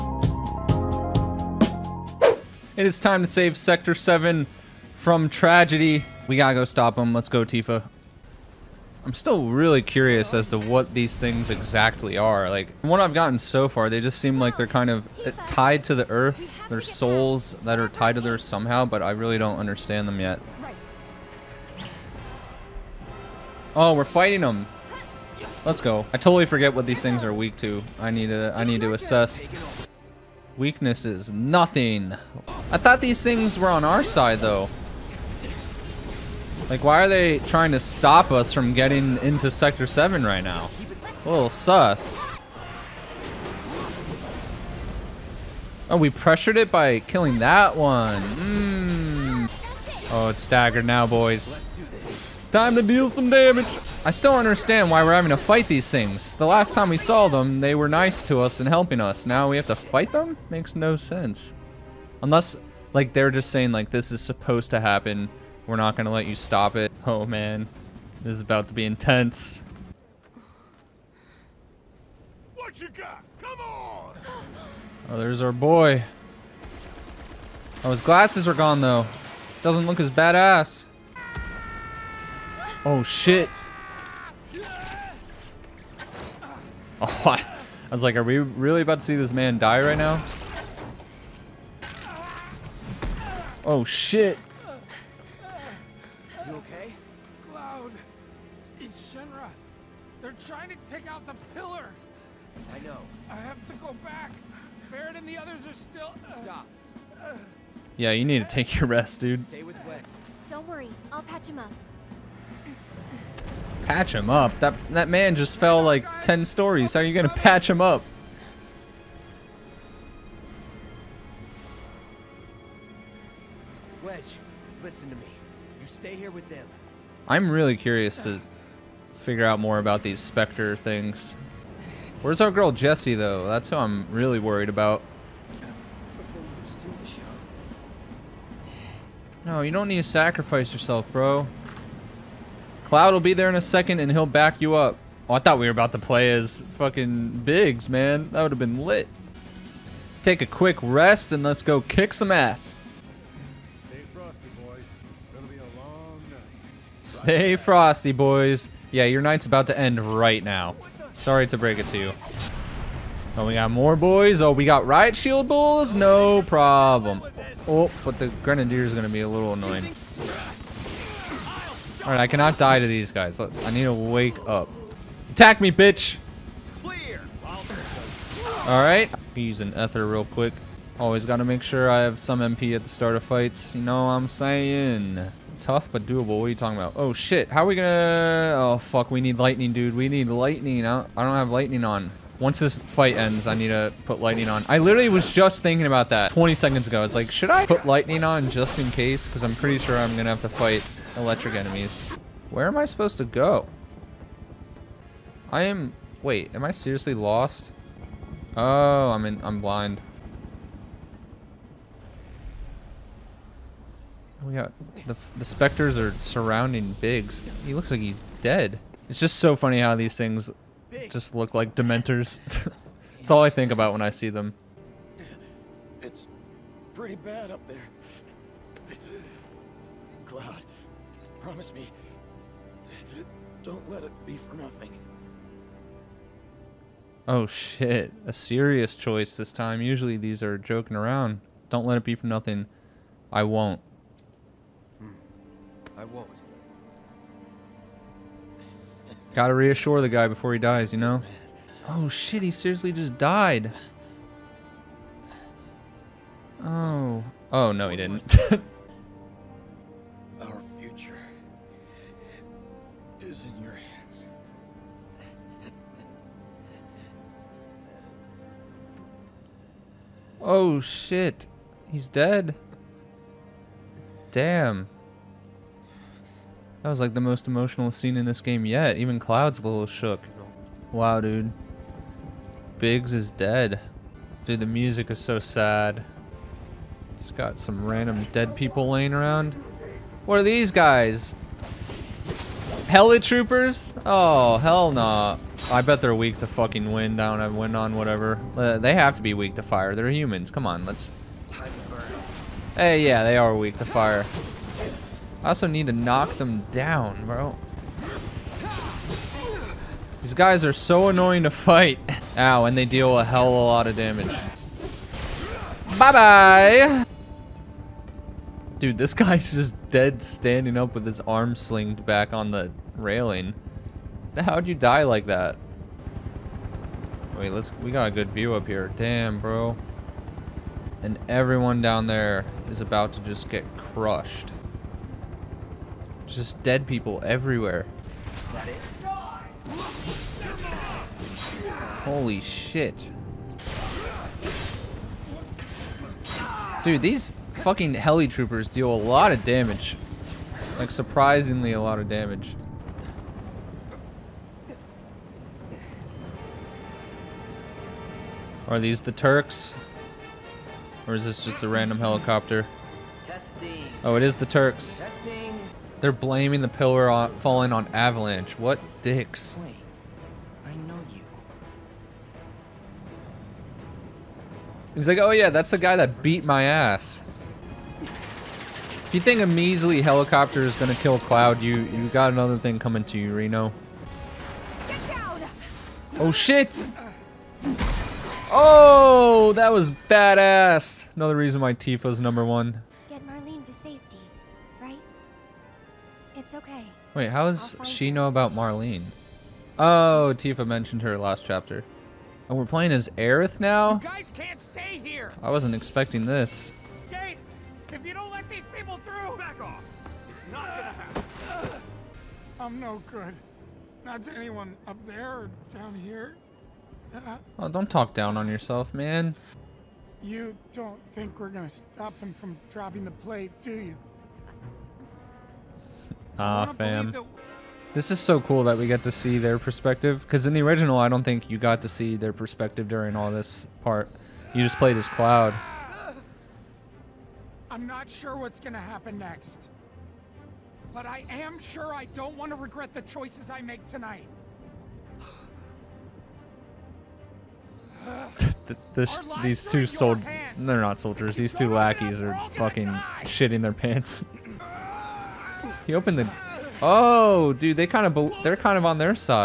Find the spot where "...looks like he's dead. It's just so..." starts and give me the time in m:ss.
3:37.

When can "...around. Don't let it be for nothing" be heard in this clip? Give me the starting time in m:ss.
4:00.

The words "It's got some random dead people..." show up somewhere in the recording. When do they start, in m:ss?
4:47.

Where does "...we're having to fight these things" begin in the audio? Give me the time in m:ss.
0:55.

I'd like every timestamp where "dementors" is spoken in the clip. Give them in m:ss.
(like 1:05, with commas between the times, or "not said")
3:41.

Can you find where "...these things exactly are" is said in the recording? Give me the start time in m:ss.
0:10.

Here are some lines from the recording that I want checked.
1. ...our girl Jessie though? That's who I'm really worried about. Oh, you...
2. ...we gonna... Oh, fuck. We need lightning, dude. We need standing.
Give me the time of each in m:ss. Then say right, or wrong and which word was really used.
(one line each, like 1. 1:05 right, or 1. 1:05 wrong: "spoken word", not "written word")
1. 2:12 right
2. 3:07 wrong: "lightning", not "standing".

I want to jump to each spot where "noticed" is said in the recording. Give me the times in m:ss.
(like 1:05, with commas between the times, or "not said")
not said.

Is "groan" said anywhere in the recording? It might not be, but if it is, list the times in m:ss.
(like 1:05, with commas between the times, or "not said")
not said.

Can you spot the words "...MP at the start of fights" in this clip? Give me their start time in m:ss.
3:02.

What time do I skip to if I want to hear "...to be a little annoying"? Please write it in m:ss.
2:49.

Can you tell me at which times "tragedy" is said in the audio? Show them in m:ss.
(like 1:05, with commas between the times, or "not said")
0:05.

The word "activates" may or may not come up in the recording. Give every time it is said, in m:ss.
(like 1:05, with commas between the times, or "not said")
not said.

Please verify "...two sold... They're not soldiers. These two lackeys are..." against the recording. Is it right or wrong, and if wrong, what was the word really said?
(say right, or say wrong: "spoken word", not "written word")
right.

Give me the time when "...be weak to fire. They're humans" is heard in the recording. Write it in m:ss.
4:59.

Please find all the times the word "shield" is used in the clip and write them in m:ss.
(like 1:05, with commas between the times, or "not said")
2:45.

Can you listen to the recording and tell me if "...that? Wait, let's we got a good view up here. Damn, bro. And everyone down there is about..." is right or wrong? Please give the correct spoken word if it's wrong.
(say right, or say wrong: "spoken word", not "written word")
right.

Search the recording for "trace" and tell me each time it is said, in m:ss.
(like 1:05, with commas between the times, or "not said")
not said.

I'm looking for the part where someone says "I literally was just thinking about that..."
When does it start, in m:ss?
3:14.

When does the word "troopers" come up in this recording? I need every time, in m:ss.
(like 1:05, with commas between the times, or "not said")
4:53, 5:48.